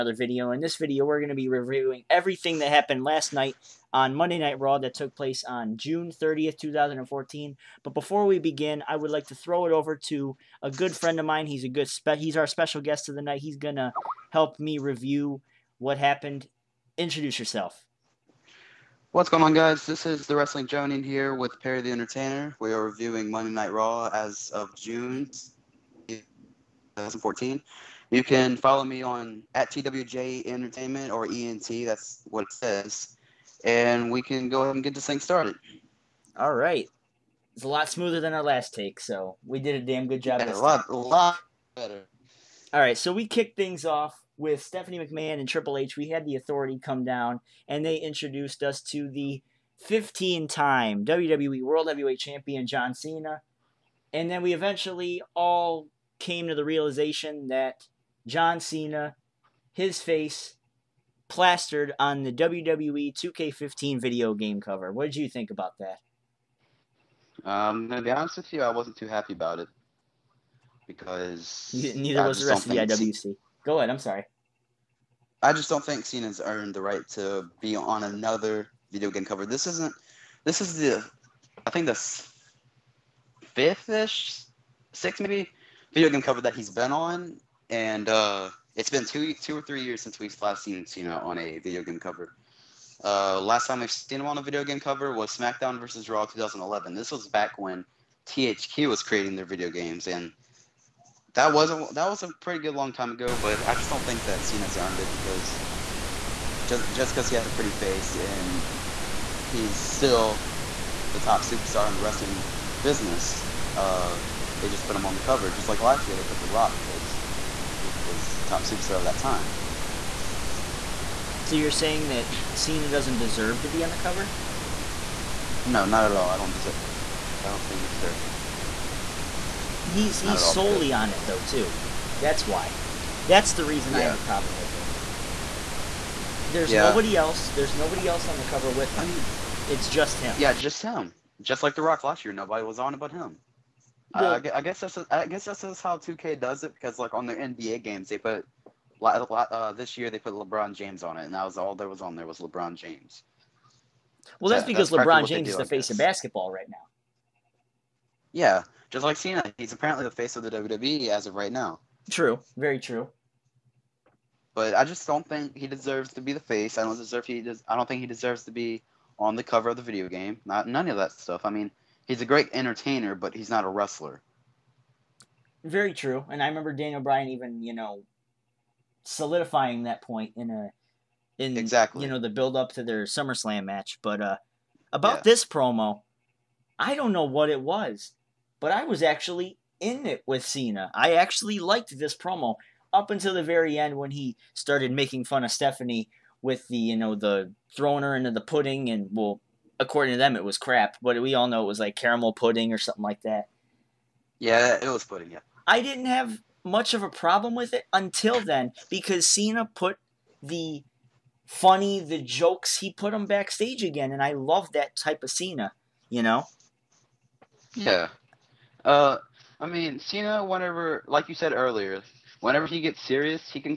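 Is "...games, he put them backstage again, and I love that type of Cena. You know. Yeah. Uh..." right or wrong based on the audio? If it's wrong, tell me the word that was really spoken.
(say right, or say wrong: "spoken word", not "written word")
wrong: "jokes", not "games".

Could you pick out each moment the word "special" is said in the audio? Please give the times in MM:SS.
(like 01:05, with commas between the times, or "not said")
00:12.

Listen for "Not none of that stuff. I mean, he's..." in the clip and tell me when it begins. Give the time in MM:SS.
02:50.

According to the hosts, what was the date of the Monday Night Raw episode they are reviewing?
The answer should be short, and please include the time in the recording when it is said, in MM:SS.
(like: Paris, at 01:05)
June 30th, 2014, at 00:05.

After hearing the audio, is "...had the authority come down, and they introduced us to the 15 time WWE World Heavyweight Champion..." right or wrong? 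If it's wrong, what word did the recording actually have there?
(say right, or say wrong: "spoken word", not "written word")
right.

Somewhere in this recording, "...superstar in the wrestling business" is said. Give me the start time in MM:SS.
01:51.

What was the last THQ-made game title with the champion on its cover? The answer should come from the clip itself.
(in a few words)
SmackDown versus Raw 2011.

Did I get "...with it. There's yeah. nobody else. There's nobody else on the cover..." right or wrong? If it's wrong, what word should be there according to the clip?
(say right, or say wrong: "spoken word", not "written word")
right.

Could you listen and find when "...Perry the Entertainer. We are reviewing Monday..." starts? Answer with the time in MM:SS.
00:21.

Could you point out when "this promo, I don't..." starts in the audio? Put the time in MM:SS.
03:05.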